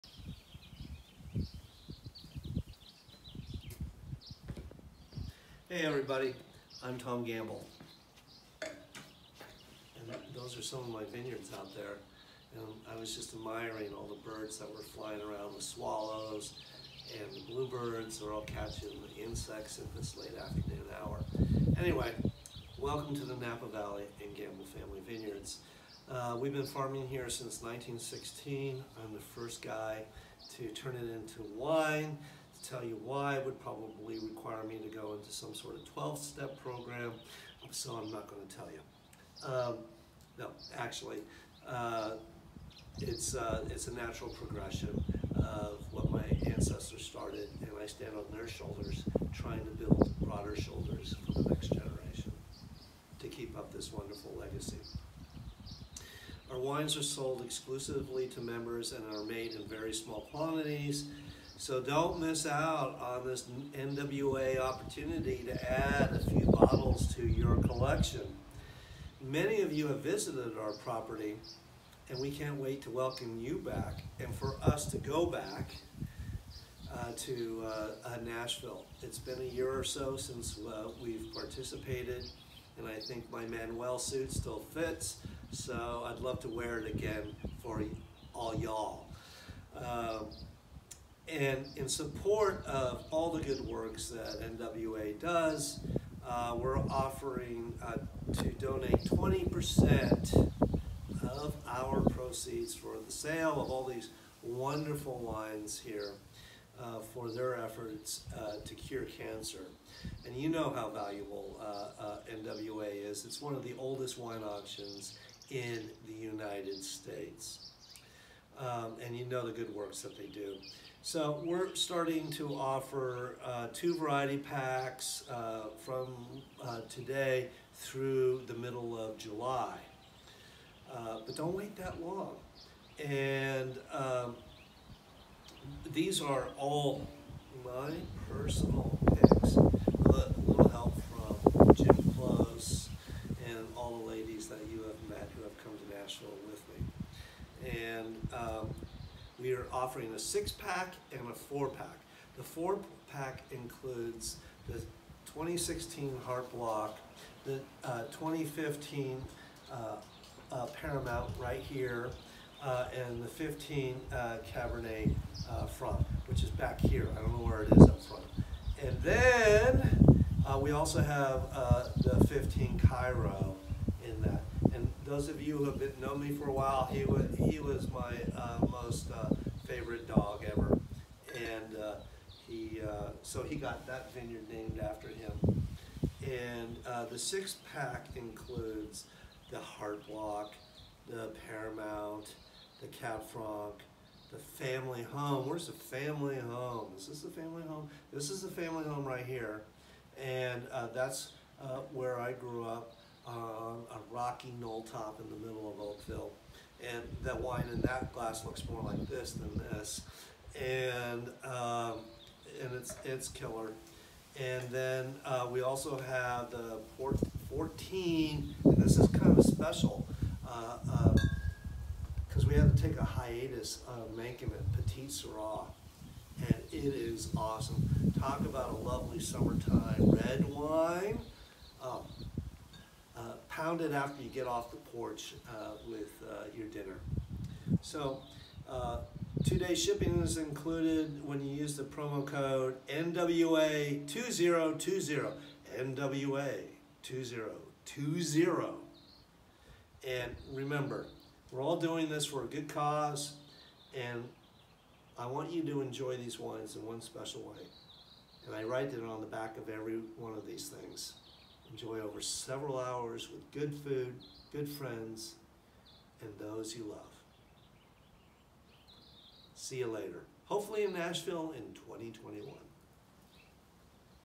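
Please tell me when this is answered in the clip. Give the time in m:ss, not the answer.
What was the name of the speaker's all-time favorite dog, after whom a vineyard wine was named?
2:52.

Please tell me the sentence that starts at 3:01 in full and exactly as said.
And uh, he, uh, so he got that vineyard named after him.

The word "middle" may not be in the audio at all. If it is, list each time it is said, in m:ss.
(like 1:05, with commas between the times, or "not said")
2:08, 3:25.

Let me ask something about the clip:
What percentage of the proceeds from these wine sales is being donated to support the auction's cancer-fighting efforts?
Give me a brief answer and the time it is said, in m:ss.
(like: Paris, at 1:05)
20%, at 1:39.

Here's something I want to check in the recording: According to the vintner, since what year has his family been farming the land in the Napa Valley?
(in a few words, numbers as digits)
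1916.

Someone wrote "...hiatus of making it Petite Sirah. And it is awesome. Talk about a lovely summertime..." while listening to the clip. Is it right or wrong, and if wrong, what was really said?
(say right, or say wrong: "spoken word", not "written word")
right.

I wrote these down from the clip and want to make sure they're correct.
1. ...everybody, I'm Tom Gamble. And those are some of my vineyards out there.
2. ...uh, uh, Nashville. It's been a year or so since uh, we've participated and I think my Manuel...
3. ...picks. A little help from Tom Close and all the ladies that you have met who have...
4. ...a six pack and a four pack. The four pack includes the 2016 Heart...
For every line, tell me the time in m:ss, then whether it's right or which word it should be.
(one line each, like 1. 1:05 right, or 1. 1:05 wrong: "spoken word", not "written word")
1. 0:05 right
2. 1:17 right
3. 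2:19 wrong: "Jim", not "Tom"
4. 2:30 right.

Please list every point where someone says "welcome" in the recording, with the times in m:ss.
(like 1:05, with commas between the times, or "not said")
0:22, 1:12.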